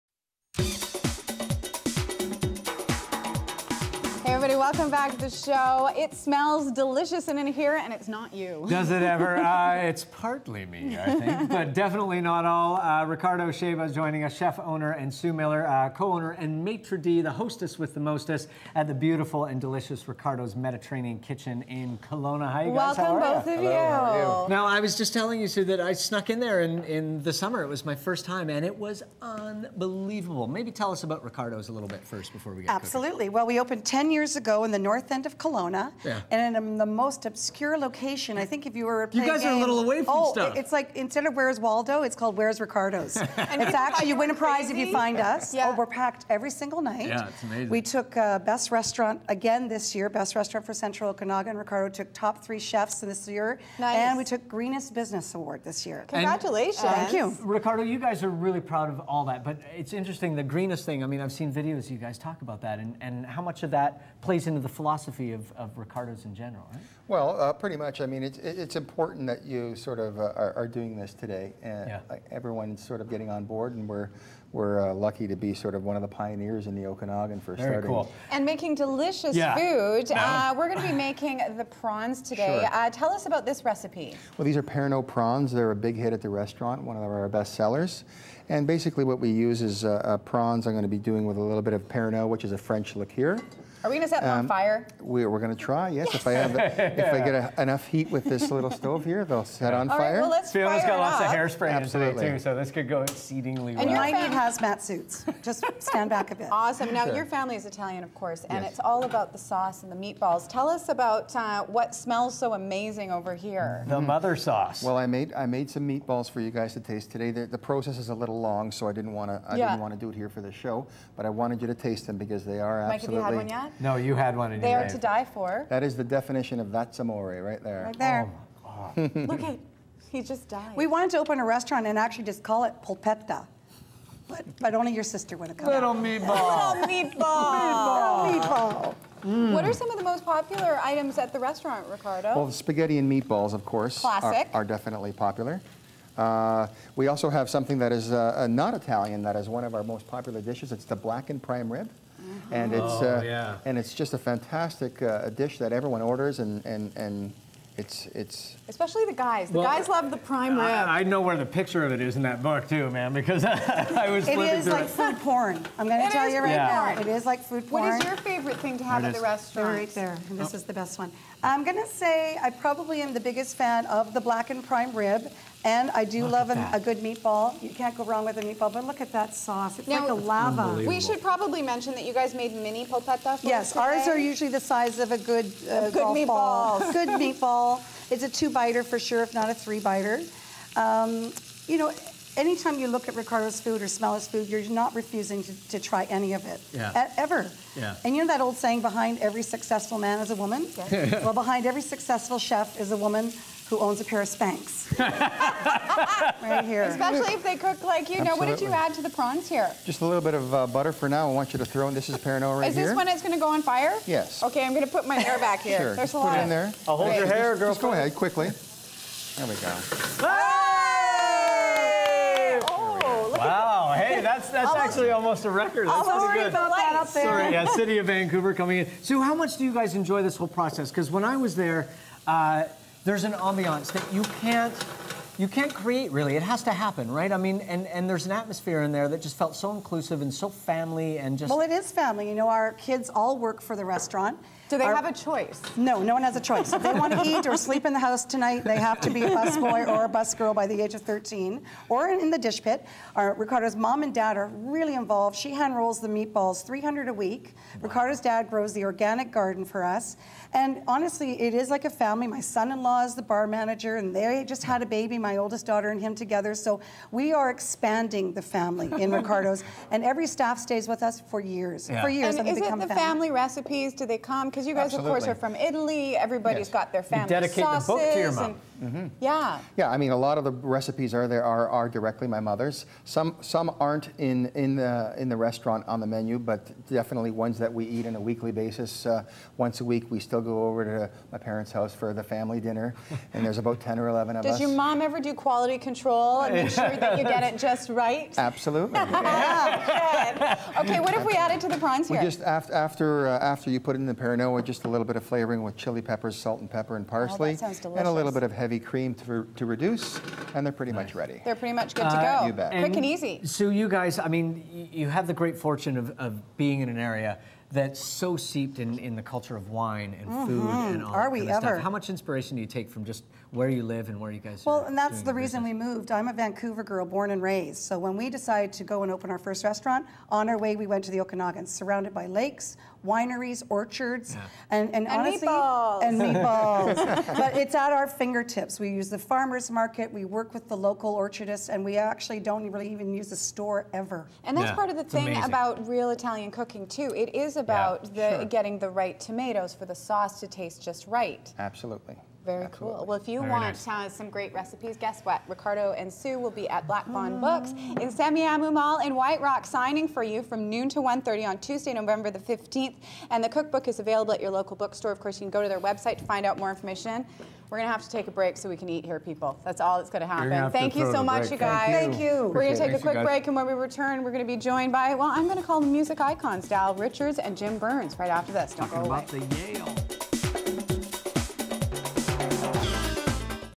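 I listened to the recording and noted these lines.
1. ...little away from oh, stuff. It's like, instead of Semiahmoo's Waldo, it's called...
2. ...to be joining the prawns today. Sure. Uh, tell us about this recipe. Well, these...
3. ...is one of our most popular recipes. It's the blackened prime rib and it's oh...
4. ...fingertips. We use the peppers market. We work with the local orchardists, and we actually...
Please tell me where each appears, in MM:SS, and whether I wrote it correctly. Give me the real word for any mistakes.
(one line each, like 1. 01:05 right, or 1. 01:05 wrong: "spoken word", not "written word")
1. 00:39 wrong: "Where", not "Semiahmoo"
2. 01:20 wrong: "making", not "joining"
3. 02:29 wrong: "dishes", not "recipes"
4. 05:38 wrong: "farmers", not "peppers".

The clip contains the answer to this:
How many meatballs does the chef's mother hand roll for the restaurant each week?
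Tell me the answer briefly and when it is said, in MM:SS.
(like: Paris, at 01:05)
300, at 04:16.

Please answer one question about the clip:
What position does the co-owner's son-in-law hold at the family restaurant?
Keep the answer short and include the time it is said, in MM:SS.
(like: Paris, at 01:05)
Bar manager, at 04:23.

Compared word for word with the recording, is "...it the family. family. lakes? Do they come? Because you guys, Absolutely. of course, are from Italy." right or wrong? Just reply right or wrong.
wrong.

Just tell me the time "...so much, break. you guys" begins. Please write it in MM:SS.
06:11.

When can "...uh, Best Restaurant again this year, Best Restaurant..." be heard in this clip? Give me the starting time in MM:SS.
00:48.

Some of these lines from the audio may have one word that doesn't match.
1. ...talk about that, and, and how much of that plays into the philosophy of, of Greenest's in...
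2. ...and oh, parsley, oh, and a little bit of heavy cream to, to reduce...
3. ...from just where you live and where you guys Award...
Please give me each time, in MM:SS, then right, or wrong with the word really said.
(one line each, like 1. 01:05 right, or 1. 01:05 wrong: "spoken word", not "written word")
1. 01:02 wrong: "Ricardo", not "Greenest"
2. 05:06 right
3. 05:22 wrong: "Well", not "Award".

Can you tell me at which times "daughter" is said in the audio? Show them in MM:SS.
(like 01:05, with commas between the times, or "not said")
04:25.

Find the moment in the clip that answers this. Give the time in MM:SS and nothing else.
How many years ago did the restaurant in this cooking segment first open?
00:33.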